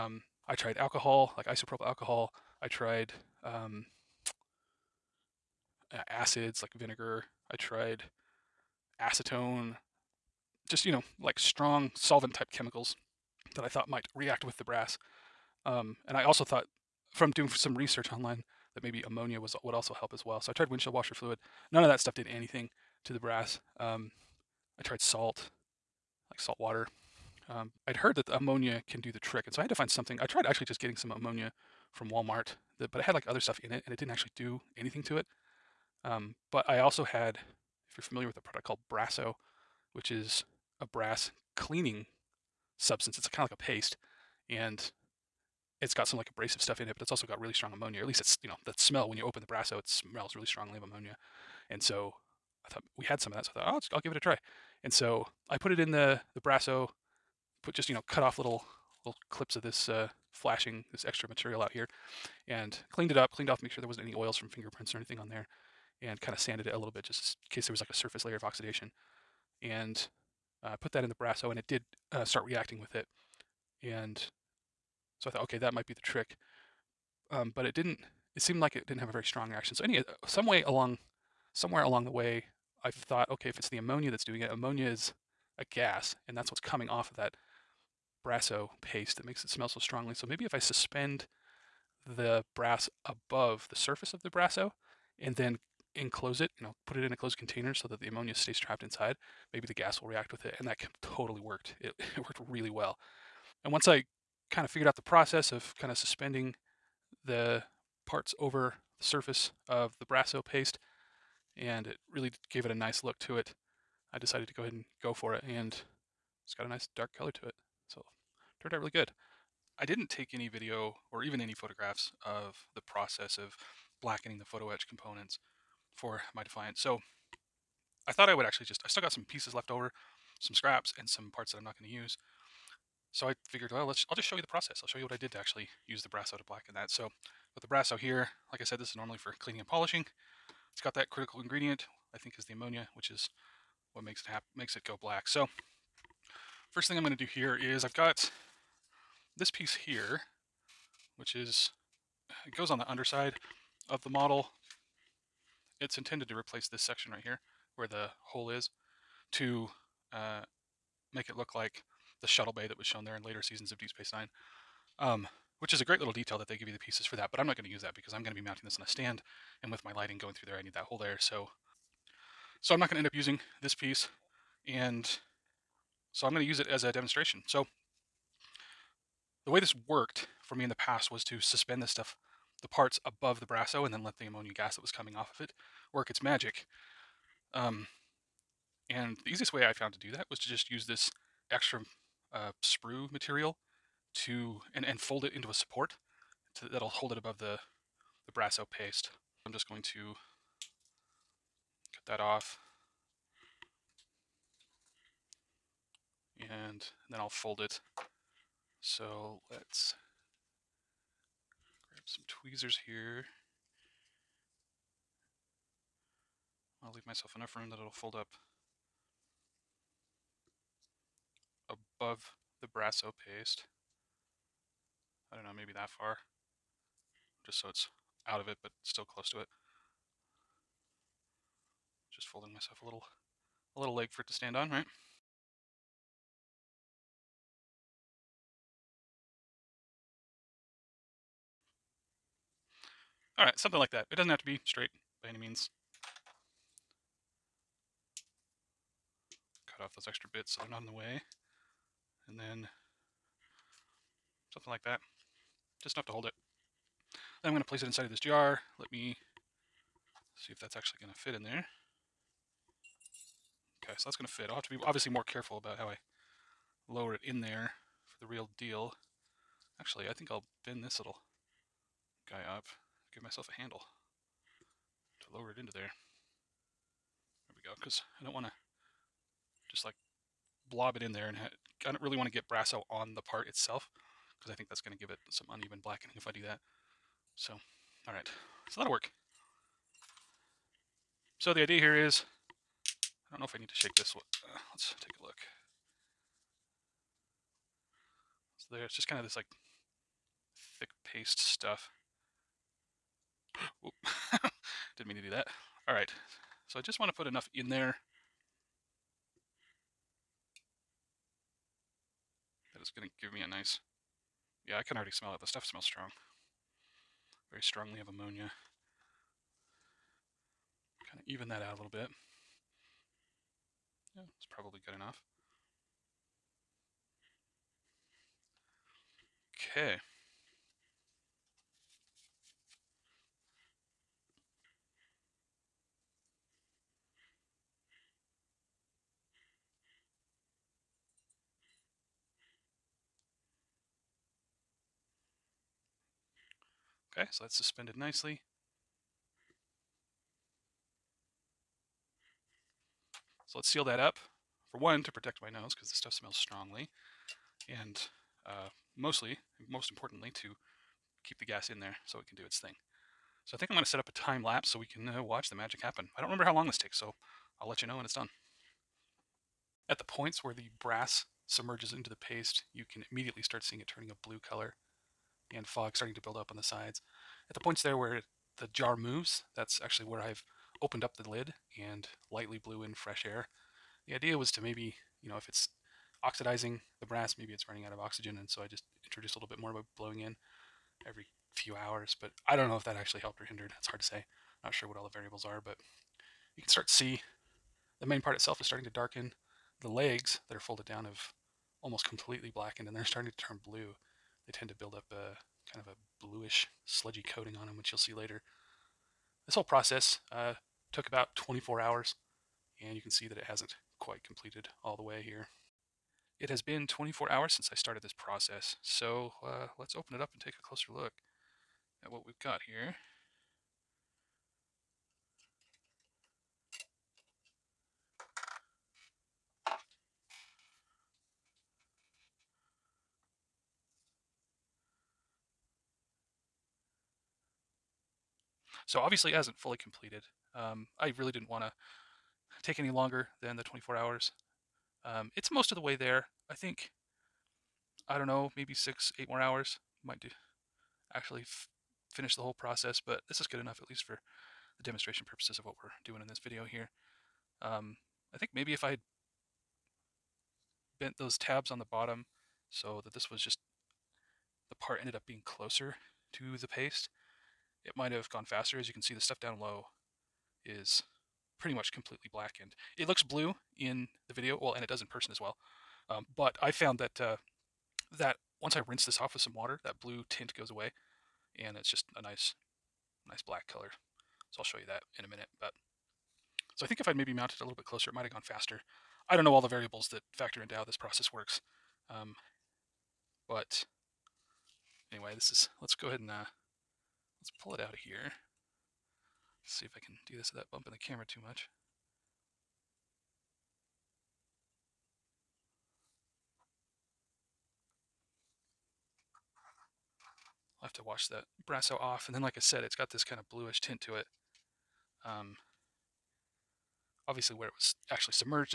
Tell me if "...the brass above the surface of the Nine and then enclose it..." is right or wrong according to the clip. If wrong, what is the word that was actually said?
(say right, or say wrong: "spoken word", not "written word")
wrong: "Brasso", not "Nine".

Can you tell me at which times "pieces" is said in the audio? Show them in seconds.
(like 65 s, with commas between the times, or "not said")
129 s, 149 s, 166 s, 173 s.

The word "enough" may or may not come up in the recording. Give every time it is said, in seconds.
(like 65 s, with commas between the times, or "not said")
217 s, 255 s, 307 s, 324 s, 453 s.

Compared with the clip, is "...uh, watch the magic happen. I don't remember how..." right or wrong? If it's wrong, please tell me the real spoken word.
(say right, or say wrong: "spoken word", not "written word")
right.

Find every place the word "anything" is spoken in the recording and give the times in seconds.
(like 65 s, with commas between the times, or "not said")
22 s, 34 s, 64 s.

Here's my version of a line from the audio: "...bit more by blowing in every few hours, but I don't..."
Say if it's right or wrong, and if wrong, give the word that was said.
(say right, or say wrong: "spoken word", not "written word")
right.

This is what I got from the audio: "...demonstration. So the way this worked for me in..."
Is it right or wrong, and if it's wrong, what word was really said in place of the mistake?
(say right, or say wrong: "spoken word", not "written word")
right.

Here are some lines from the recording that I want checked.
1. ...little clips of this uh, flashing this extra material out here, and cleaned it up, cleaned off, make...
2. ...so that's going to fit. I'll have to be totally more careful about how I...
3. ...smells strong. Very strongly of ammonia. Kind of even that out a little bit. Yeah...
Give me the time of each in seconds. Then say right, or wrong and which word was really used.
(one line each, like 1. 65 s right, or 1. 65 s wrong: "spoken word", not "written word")
1. 59 s right
2. 263 s wrong: "obviously", not "totally"
3. 315 s right.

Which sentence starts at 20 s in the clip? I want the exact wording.
So I tried windshield washer fluid.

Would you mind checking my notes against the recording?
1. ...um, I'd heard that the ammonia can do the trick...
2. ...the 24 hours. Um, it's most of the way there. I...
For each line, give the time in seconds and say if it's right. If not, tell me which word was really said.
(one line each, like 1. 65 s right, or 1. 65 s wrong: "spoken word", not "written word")
1. 27 s right
2. 443 s right.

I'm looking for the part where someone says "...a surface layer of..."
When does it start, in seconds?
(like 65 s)
67 s.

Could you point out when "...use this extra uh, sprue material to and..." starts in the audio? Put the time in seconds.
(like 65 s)
190 s.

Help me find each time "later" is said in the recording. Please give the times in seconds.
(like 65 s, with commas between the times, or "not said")
163 s, 408 s.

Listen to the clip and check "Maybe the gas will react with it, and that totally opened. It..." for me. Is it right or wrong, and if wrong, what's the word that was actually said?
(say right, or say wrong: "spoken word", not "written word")
wrong: "worked", not "opened".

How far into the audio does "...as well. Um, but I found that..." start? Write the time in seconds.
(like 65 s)
475 s.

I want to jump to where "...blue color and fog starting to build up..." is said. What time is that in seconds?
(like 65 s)
374 s.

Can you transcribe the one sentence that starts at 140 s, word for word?
It's got that critical ingredient, I think is the ammonia, which is what makes it hap makes it go black.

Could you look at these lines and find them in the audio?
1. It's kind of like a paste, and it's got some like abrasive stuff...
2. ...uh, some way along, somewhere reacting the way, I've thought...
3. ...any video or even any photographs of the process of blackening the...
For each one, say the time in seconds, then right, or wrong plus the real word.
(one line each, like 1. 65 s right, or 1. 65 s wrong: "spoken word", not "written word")
1. 43 s right
2. 79 s wrong: "along", not "reacting"
3. 120 s right.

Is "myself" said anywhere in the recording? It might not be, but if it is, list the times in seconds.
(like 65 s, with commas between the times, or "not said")
217 s, 232 s, 273 s.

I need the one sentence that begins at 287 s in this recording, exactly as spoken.
So, all right, so that'll work.